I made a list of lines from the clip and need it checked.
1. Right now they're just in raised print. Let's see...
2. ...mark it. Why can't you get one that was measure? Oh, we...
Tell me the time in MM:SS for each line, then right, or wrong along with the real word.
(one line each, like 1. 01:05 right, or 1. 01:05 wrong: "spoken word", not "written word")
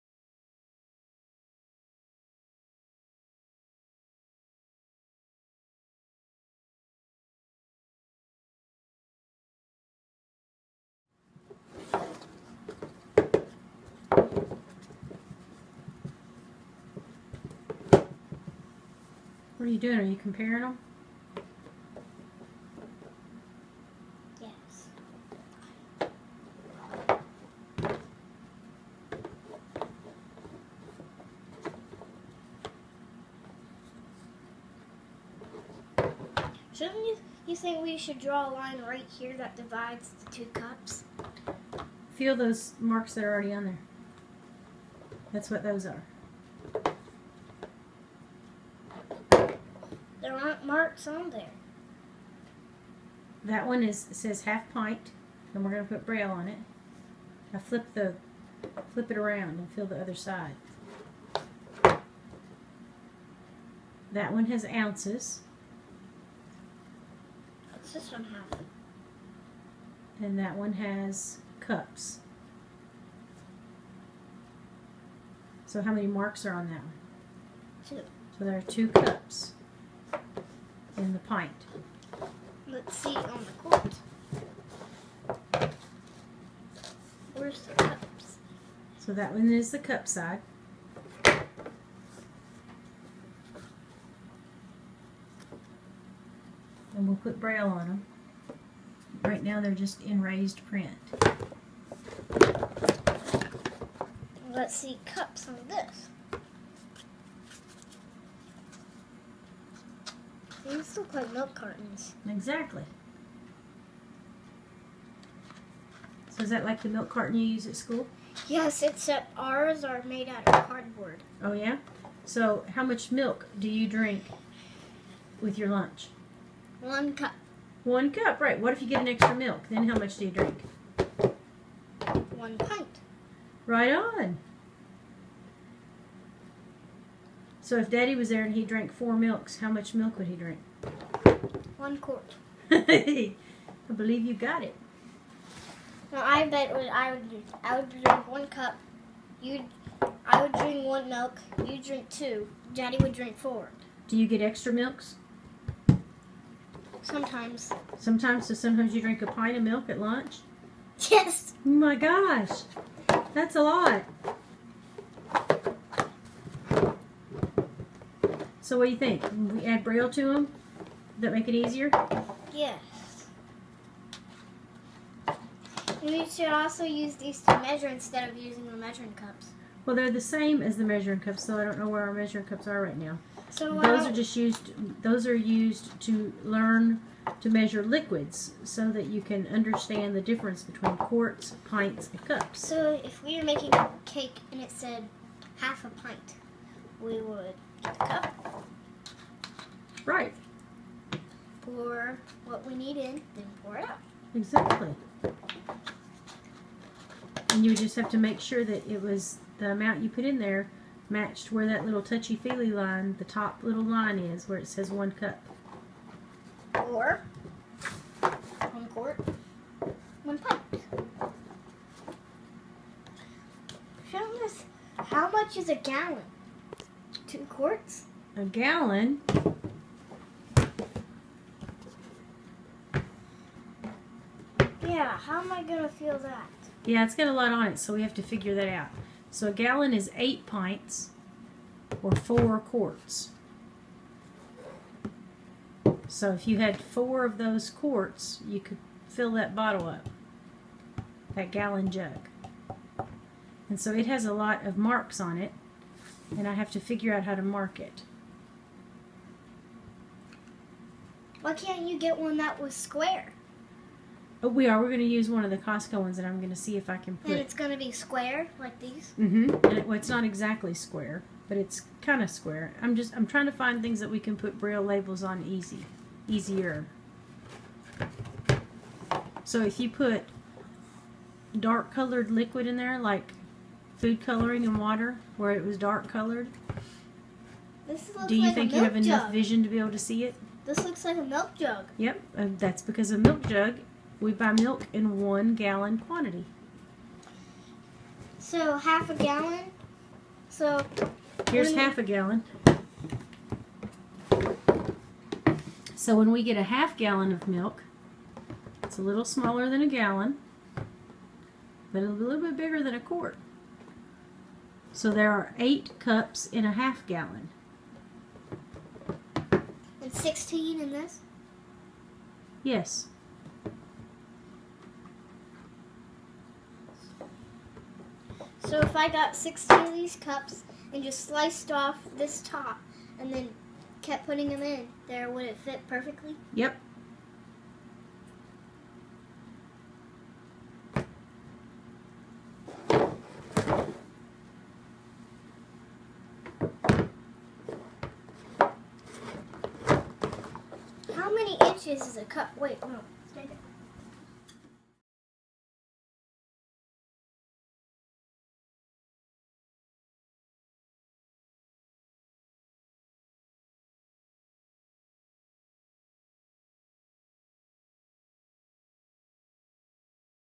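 1. 01:39 right
2. 04:17 wrong: "square", not "measure".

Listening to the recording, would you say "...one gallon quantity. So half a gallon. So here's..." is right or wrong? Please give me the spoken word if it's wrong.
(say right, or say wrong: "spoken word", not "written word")
right.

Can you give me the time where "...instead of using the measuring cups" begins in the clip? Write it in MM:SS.
02:57.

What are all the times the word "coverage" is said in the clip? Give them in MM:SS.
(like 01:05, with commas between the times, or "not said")
not said.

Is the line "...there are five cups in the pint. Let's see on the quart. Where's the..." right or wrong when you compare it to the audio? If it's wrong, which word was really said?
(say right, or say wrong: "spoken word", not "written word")
wrong: "two", not "five".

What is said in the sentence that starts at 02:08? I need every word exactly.
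What if you get an extra milk?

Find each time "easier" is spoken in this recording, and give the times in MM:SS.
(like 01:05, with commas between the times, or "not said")
02:51, 04:36.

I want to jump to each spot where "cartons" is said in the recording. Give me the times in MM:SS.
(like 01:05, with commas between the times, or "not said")
01:51, 01:57.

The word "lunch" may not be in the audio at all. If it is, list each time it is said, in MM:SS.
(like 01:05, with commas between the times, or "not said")
02:05, 02:39.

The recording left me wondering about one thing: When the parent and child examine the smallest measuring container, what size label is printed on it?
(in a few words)
half pint.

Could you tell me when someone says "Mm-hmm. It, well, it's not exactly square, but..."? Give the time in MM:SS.
04:29.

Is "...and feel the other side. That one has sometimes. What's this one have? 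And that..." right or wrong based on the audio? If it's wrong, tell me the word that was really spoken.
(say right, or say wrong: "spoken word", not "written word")
wrong: "ounces", not "sometimes".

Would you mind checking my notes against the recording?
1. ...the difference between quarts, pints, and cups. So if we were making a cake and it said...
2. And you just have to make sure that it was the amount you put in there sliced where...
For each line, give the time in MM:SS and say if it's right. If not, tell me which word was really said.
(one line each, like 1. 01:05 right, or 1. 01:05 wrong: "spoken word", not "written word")
1. 03:10 right
2. 03:27 wrong: "matched", not "sliced".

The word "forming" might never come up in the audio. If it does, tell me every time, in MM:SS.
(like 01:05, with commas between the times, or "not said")
not said.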